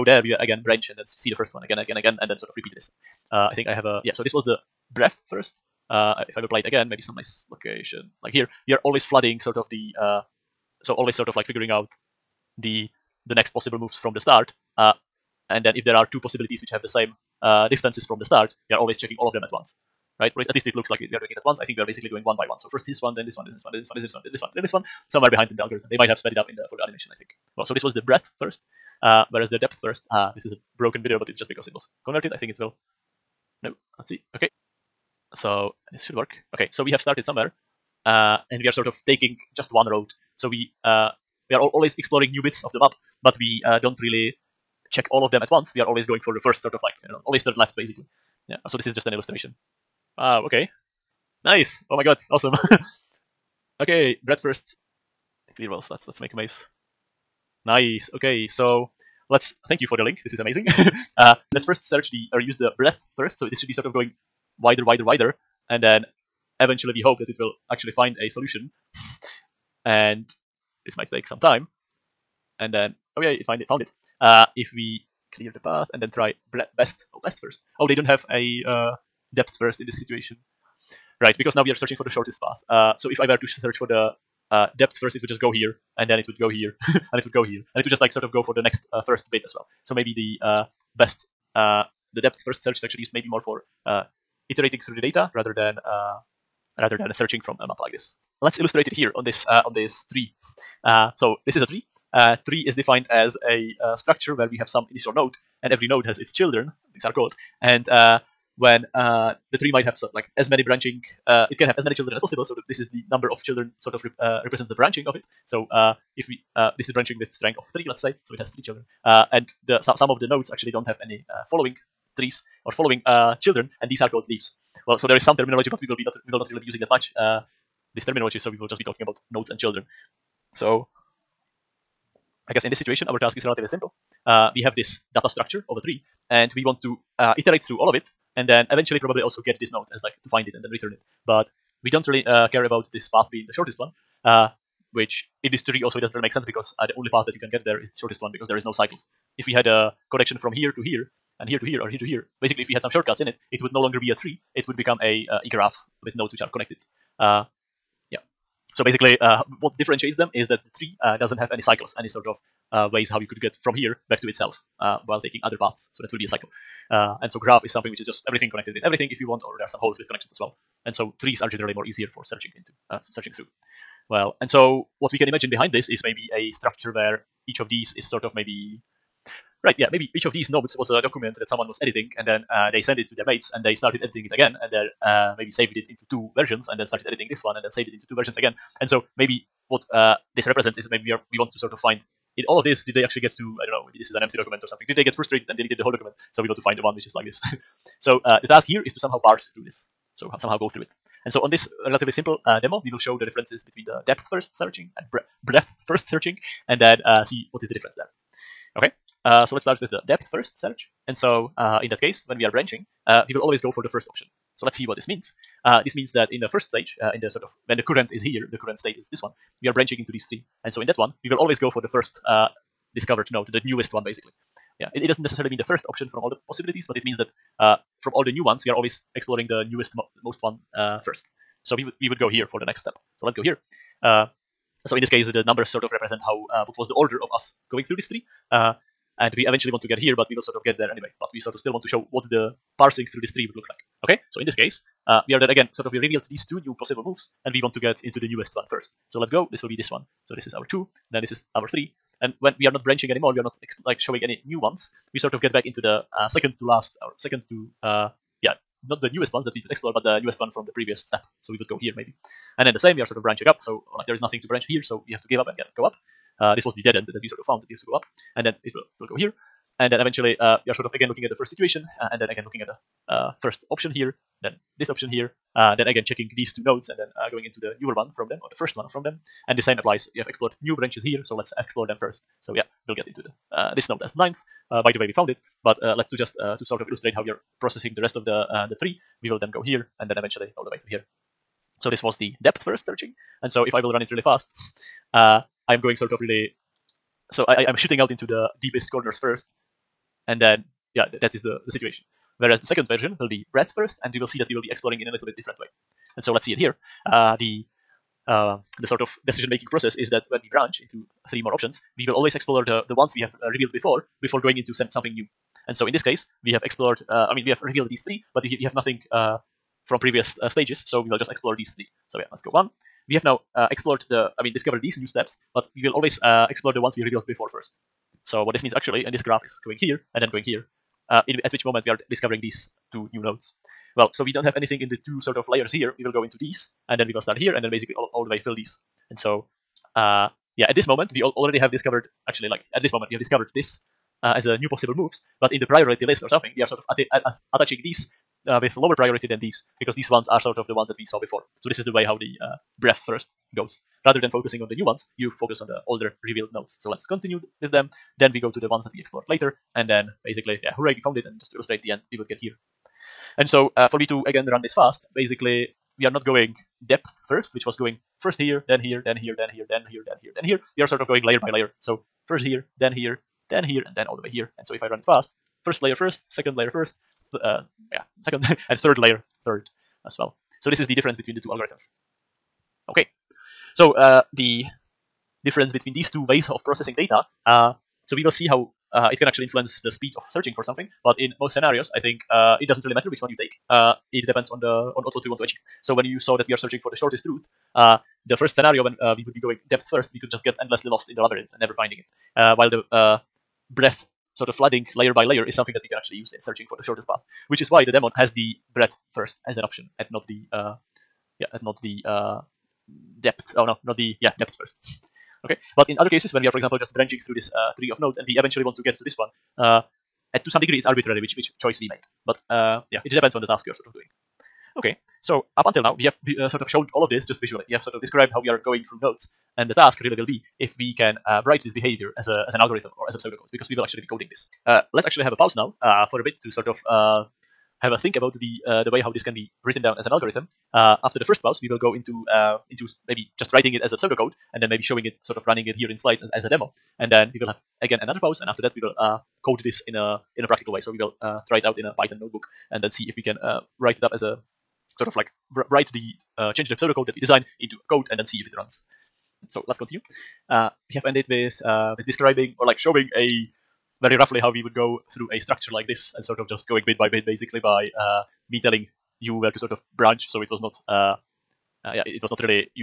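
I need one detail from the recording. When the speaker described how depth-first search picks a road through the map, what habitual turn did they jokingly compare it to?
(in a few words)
always third left.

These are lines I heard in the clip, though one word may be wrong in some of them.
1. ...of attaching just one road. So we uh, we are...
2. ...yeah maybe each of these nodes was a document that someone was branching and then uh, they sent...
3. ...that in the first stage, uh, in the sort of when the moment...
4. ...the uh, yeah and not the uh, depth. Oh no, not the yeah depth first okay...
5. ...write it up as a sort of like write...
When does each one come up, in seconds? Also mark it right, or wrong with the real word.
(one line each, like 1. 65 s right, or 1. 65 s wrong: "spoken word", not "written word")
1. 38 s wrong: "taking", not "attaching"
2. 179 s wrong: "editing", not "branching"
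3. 216 s wrong: "current", not "moment"
4. 410 s right
5. 453 s right.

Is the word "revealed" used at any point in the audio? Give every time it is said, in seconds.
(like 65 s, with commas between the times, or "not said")
245 s, 313 s, 317 s, 327 s, 356 s.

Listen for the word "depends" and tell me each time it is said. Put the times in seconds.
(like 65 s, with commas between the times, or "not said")
394 s, 423 s.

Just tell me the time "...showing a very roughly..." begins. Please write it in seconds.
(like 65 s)
462 s.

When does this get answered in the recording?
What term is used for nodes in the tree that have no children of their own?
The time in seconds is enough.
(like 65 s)
124 s.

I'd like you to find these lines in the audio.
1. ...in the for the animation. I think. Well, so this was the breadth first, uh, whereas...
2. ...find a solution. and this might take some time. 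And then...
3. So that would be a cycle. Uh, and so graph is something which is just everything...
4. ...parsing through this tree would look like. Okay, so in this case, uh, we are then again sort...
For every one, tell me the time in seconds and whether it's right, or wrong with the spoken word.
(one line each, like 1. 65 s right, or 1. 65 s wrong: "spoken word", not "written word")
1. 26 s right
2. 67 s right
3. 165 s right
4. 242 s right.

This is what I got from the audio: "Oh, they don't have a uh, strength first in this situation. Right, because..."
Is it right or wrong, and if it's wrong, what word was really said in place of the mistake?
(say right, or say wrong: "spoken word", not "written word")
wrong: "depth", not "strength".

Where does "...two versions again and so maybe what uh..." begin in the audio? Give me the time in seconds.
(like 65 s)
188 s.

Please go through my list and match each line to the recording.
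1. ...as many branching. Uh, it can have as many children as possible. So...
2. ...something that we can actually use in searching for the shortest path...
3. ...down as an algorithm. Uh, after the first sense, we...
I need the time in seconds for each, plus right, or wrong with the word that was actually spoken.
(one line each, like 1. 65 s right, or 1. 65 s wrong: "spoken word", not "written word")
1. 110 s right
2. 405 s right
3. 439 s wrong: "pause", not "sense".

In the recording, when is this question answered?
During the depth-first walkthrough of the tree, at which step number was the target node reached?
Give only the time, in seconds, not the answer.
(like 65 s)
284 s.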